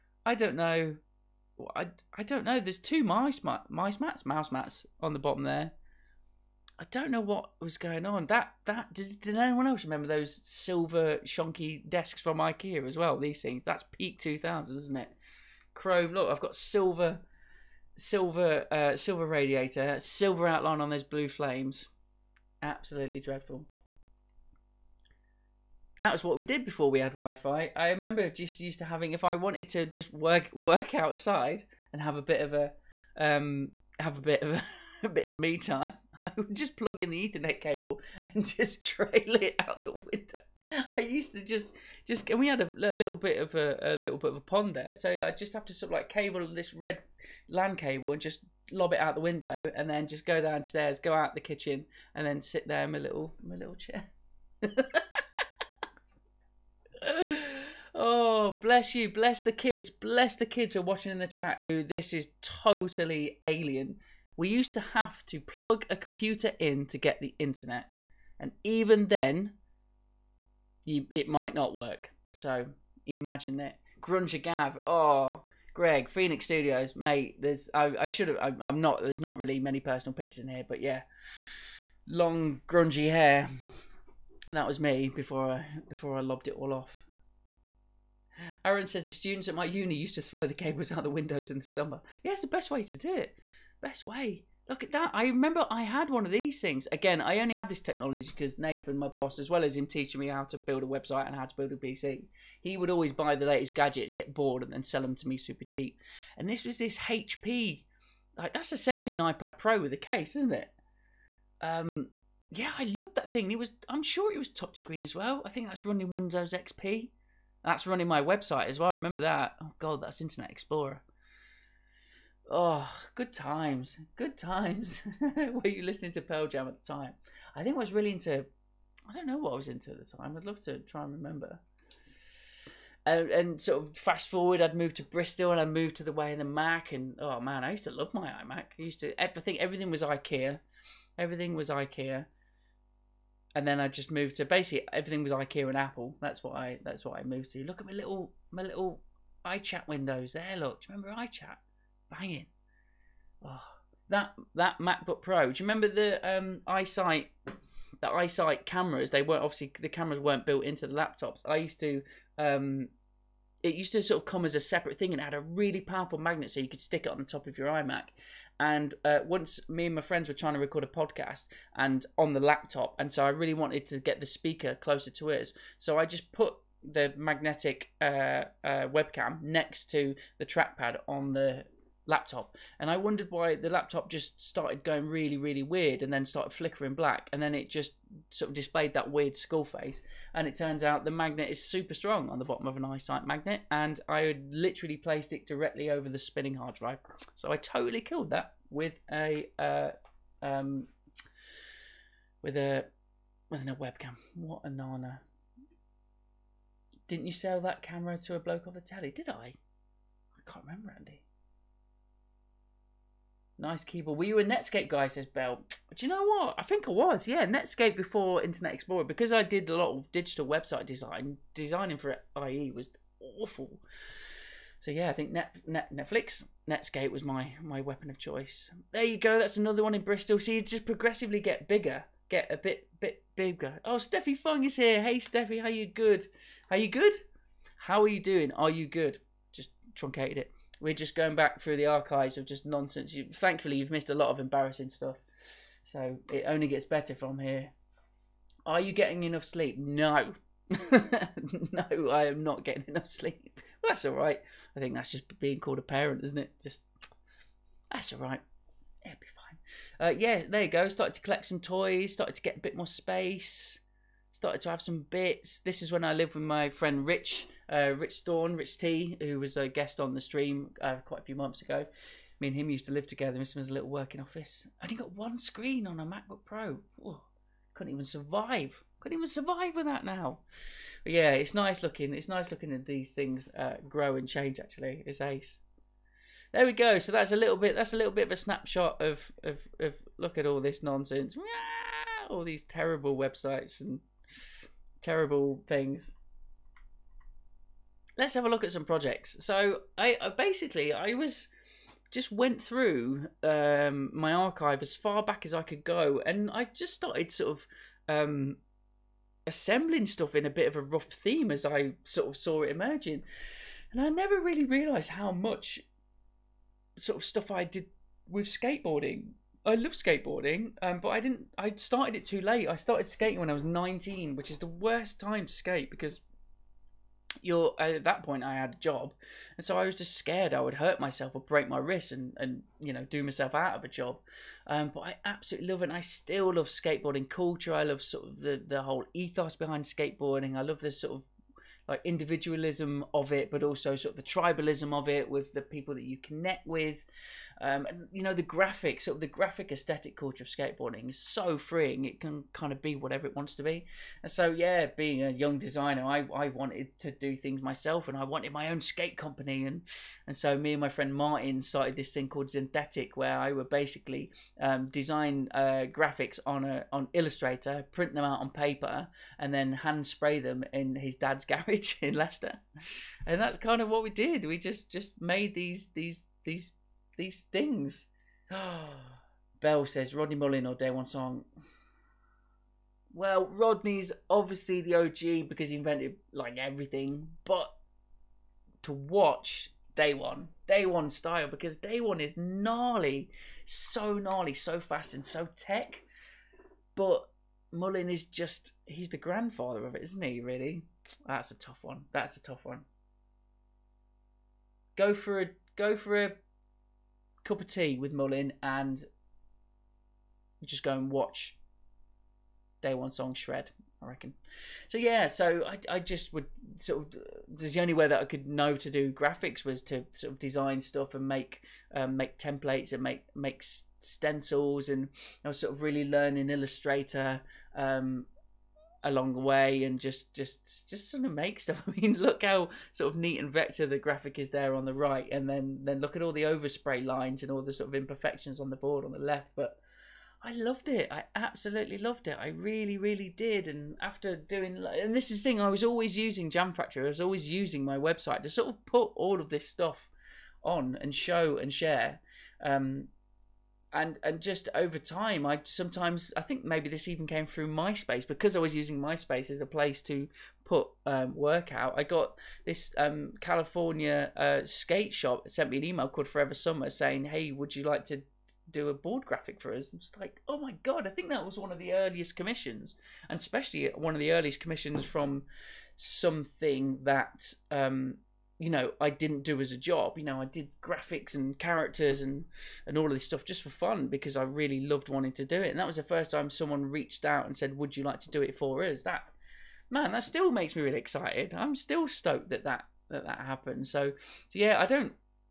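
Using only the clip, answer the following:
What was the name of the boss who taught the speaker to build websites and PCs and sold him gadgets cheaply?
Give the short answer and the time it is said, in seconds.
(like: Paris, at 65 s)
Nathan, at 98 s.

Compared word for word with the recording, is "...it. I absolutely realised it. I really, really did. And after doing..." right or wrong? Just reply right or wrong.
wrong.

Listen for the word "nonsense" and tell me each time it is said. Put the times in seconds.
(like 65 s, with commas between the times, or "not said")
242 s, 290 s.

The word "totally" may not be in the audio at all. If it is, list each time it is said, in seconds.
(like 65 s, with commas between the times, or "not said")
62 s, 197 s.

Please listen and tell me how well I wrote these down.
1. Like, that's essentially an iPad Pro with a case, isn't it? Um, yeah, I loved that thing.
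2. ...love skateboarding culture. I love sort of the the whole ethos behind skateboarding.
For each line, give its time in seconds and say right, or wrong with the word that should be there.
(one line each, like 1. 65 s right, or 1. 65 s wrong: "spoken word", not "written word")
1. 108 s right
2. 336 s right.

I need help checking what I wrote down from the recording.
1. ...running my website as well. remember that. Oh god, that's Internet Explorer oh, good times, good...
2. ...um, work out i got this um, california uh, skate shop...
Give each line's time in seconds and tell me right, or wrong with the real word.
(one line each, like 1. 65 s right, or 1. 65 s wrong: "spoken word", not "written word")
1. 117 s right
2. 461 s right.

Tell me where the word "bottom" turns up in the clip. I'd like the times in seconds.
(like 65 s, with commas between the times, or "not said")
5 s, 192 s.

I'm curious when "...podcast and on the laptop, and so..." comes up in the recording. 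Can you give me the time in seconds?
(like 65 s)
170 s.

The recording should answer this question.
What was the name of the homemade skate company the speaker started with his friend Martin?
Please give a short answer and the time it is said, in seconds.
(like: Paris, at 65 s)
Synthetic, at 362 s.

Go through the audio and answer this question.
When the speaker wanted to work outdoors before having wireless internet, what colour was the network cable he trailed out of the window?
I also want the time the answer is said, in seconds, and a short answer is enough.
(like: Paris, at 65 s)
Red, at 46 s.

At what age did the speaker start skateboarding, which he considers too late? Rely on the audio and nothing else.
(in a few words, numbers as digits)
19.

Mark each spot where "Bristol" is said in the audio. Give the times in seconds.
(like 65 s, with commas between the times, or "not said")
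135 s, 230 s.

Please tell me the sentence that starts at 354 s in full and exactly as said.
And so yeah, being a young designer, I, I wanted to do things myself, and I wanted my own skate company.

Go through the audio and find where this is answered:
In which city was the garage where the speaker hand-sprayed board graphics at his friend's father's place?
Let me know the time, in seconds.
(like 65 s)
372 s.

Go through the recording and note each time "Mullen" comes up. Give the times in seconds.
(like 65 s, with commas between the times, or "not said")
380 s, 397 s, 408 s.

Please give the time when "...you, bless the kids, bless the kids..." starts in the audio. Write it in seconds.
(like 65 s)
58 s.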